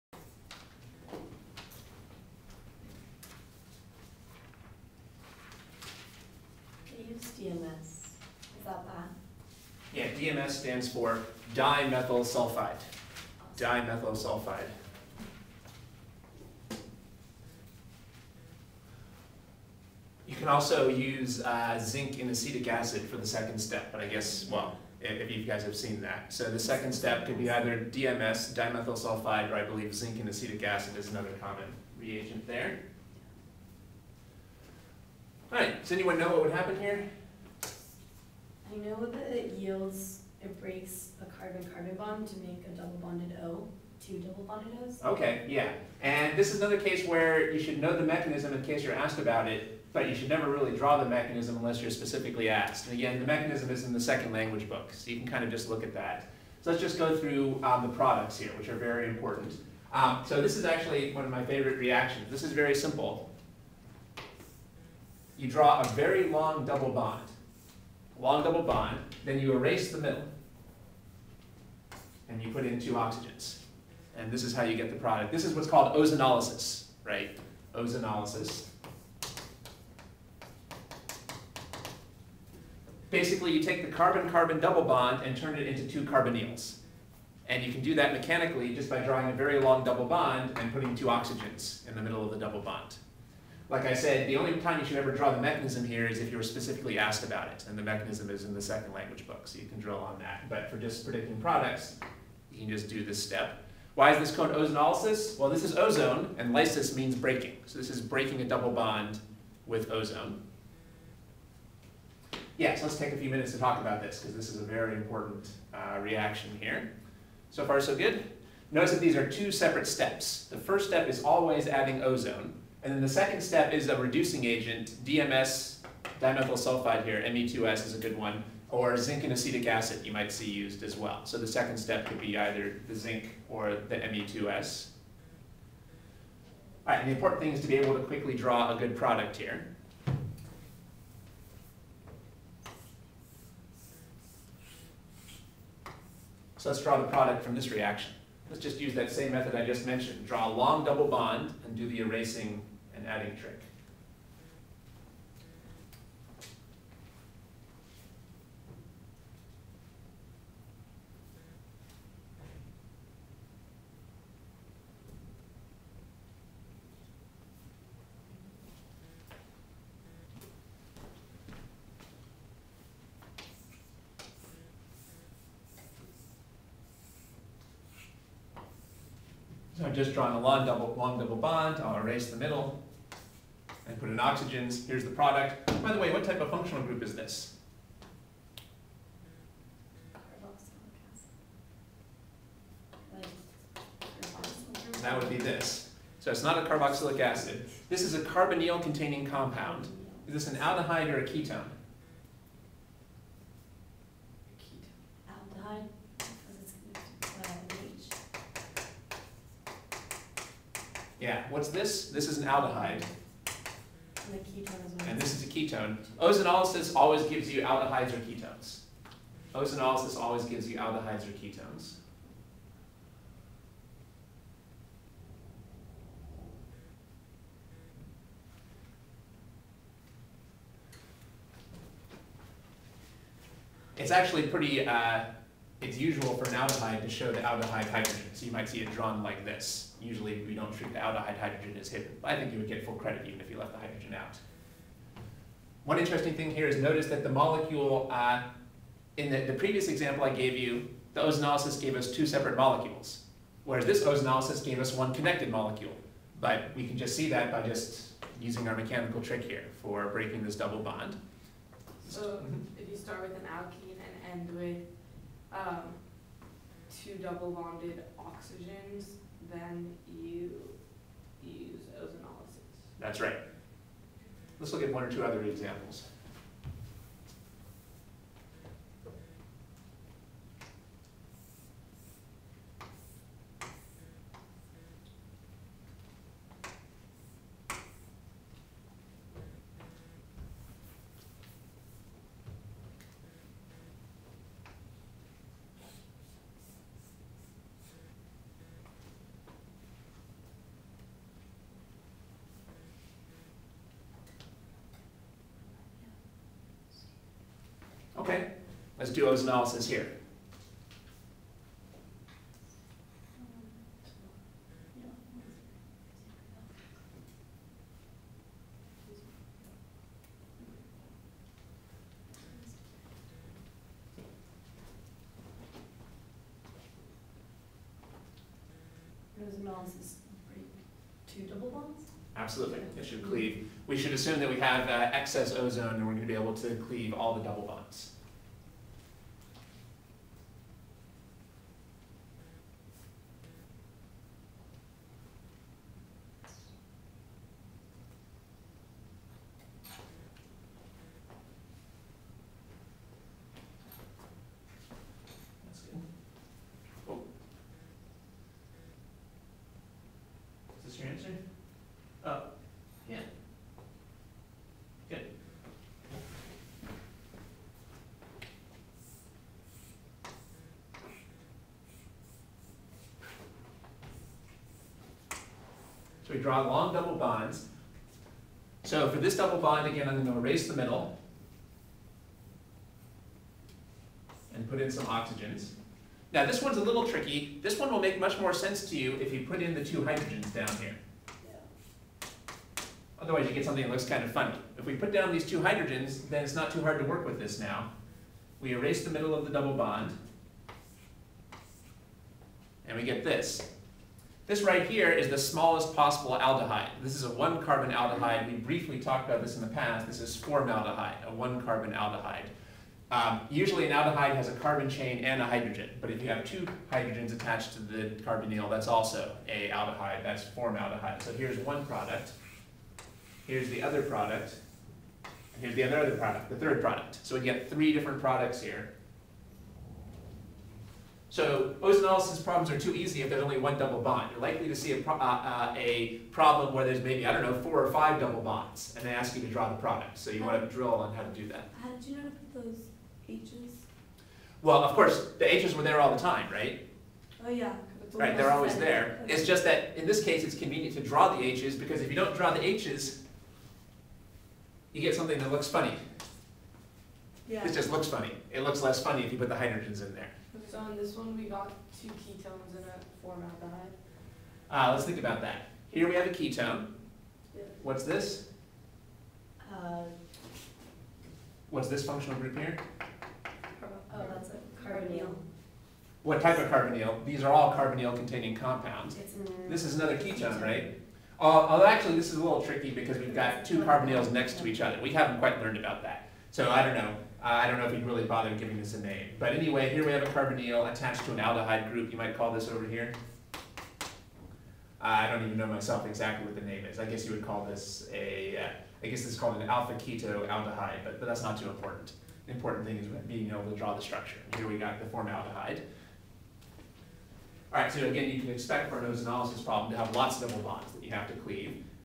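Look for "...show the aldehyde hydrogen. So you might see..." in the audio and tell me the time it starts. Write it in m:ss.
3:57.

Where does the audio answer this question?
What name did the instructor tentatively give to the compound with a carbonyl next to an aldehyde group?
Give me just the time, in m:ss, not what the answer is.
8:19.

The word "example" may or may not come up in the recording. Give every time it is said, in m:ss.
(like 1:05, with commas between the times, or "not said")
4:09, 4:35.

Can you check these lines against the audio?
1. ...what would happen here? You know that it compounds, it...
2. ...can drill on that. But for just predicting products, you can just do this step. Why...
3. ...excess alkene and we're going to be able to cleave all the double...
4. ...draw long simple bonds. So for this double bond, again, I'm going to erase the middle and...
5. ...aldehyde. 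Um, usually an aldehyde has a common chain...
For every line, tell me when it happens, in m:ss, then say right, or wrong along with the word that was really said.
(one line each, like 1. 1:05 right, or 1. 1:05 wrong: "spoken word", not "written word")
1. 0:36 wrong: "yields", not "compounds"
2. 1:39 right
3. 5:35 wrong: "ozone", not "alkene"
4. 6:16 wrong: "double", not "simple"
5. 6:51 wrong: "carbon", not "common".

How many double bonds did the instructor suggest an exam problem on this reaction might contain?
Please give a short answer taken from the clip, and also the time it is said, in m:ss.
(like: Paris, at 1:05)
4 or 5, at 7:17.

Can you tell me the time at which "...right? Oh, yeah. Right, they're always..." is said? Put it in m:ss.
7:26.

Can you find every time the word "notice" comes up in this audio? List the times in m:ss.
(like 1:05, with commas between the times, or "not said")
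1:58, 4:06.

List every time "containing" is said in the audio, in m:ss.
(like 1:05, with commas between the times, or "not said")
3:18, 7:57.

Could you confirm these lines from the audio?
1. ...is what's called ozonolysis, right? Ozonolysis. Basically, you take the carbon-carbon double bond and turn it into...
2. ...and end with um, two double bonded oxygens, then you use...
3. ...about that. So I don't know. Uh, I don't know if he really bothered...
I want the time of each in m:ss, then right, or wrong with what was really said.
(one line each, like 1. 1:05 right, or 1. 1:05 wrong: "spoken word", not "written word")
1. 1:15 right
2. 4:24 right
3. 8:05 right.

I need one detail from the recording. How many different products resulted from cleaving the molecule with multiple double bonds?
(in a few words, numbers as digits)
3.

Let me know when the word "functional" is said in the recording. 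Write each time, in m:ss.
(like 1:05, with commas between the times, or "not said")
3:06, 7:52.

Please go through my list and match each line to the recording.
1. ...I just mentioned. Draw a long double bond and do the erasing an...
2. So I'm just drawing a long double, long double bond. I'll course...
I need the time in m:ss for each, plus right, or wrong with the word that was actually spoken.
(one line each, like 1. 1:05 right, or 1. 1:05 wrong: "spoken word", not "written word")
1. 2:29 right
2. 2:59 wrong: "erase", not "course".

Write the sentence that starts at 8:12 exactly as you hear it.
You might call this over here.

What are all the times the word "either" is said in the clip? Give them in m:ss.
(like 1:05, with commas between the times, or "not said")
0:27, 2:12.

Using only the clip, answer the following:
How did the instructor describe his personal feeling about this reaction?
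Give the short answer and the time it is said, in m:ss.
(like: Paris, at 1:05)
one of my favorite reactions, at 1:01.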